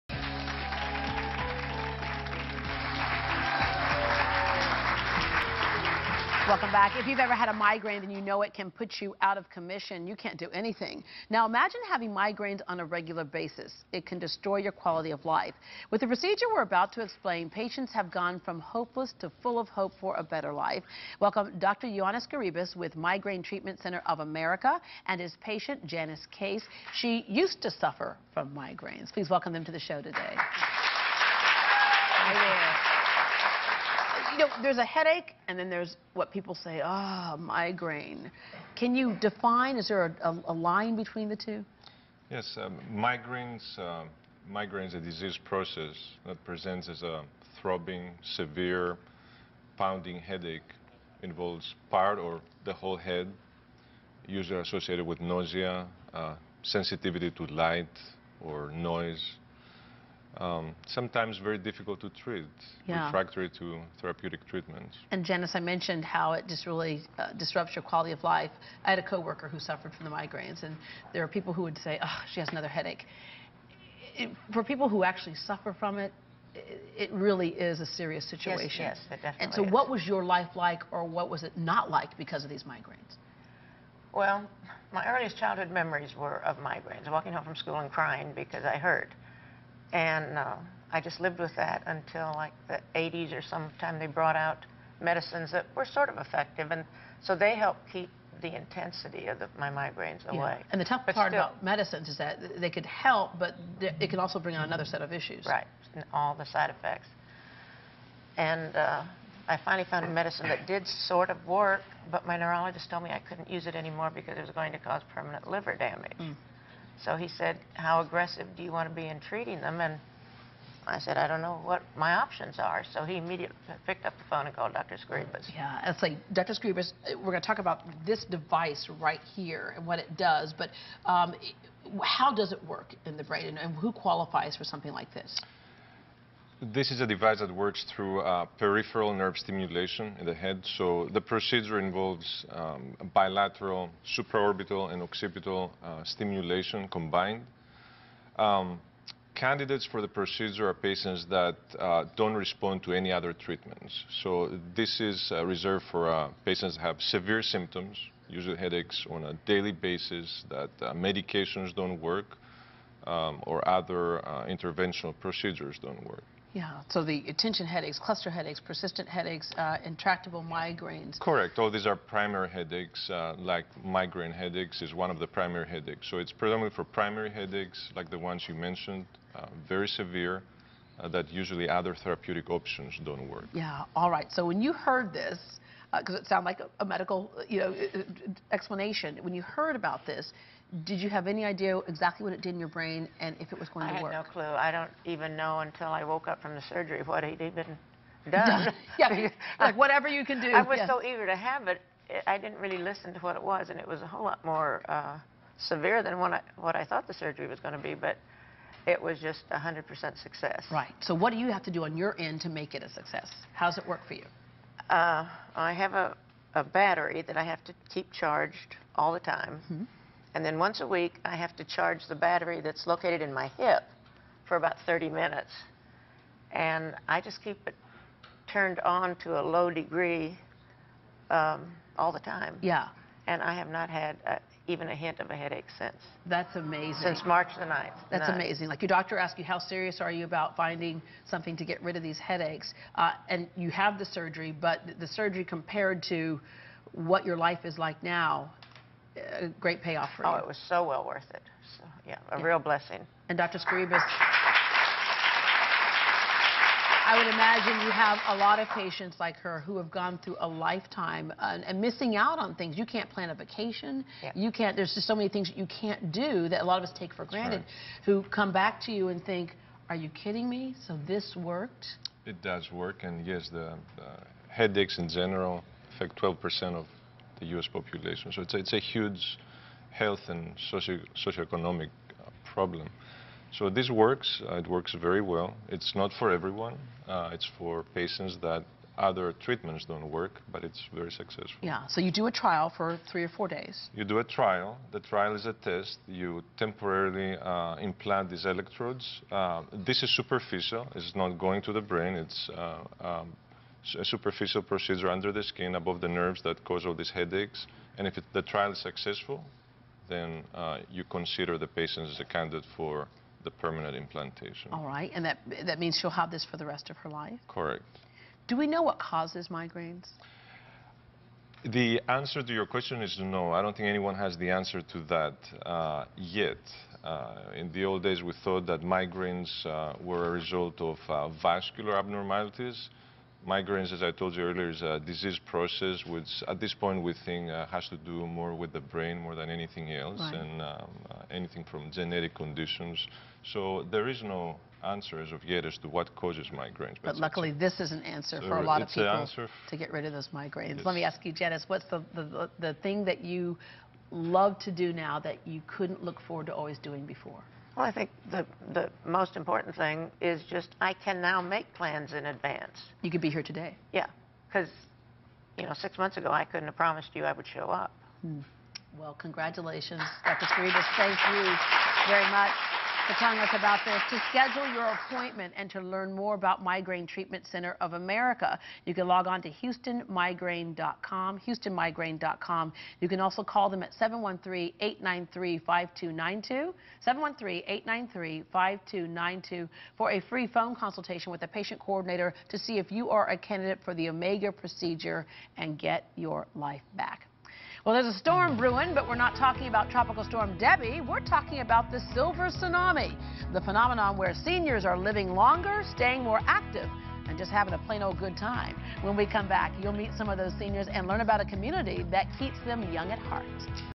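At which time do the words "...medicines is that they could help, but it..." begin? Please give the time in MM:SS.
01:41.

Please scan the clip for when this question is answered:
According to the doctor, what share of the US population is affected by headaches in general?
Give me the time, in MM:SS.
04:36.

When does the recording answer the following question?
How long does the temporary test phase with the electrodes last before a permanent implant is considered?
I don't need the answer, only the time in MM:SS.
04:53.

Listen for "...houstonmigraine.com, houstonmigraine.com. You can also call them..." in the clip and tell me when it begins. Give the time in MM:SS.
06:19.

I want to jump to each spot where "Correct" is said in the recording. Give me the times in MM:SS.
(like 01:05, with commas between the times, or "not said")
02:51, 05:17.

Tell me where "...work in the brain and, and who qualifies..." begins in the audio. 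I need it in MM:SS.
02:12.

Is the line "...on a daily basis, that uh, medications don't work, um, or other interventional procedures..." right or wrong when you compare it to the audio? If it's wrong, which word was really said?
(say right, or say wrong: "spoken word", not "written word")
right.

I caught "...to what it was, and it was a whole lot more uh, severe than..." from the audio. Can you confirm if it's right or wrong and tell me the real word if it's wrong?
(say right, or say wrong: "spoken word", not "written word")
right.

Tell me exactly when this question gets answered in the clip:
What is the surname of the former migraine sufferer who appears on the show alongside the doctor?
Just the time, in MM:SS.
00:26.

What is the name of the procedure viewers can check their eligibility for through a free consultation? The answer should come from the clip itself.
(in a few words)
Omega.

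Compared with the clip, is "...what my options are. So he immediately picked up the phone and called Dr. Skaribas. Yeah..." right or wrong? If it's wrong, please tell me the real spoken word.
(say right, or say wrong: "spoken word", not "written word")
right.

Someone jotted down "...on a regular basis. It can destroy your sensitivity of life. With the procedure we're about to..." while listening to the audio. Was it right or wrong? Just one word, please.
wrong.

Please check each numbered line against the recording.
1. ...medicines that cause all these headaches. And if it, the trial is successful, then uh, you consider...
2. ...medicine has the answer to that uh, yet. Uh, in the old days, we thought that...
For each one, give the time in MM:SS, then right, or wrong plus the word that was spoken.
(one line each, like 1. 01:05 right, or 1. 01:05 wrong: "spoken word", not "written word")
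1. 05:06 wrong: "nerves", not "medicines"
2. 05:23 wrong: "anyone", not "medicine".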